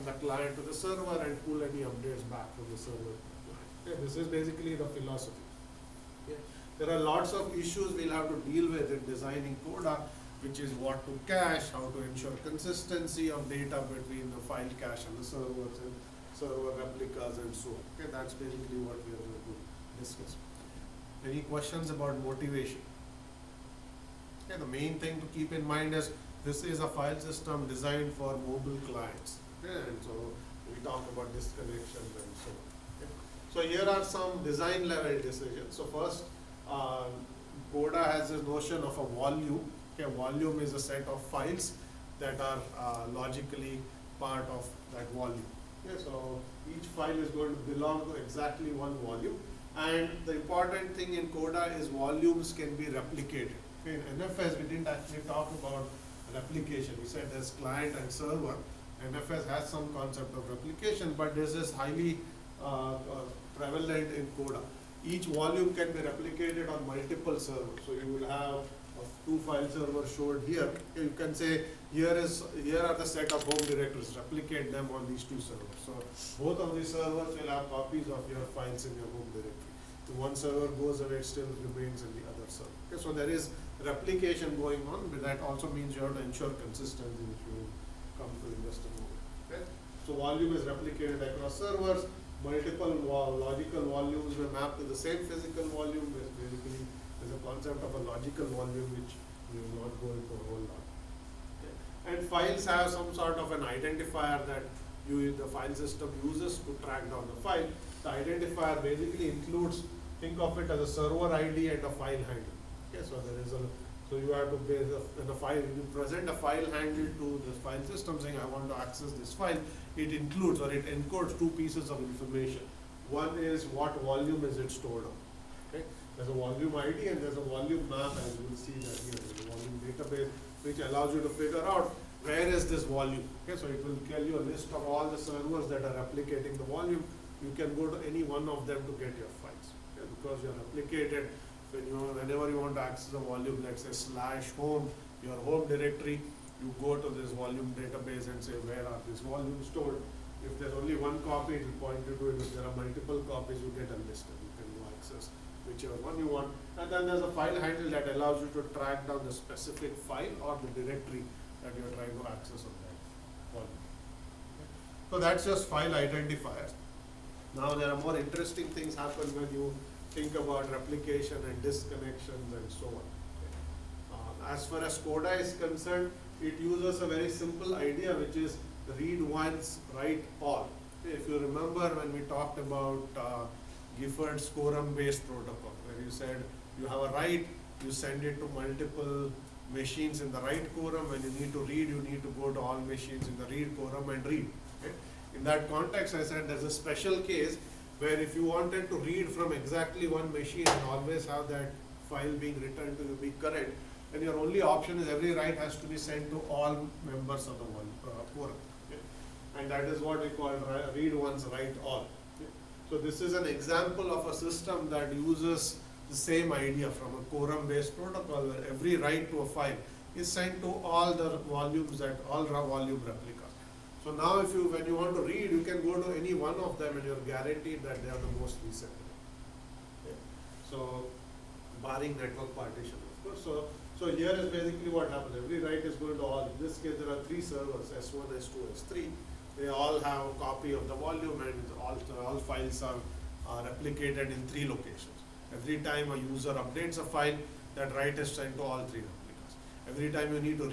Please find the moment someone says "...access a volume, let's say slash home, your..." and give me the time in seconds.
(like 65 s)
142 s.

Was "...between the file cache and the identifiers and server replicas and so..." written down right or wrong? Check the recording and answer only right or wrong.
wrong.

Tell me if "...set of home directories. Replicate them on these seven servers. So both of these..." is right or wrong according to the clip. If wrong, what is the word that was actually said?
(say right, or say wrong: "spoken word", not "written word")
wrong: "two", not "seven".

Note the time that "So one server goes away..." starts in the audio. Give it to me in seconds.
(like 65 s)
80 s.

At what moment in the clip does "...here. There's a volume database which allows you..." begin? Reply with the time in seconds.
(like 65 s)
129 s.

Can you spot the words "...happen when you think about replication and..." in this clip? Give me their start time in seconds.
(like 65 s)
168 s.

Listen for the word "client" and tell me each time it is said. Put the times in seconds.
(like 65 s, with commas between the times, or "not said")
0 s, 28 s, 57 s.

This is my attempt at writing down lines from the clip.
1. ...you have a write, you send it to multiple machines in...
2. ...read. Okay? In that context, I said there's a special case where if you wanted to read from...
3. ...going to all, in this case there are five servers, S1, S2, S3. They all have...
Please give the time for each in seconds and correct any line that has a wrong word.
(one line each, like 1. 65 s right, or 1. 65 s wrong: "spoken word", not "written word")
1. 186 s right
2. 194 s right
3. 235 s wrong: "three", not "five".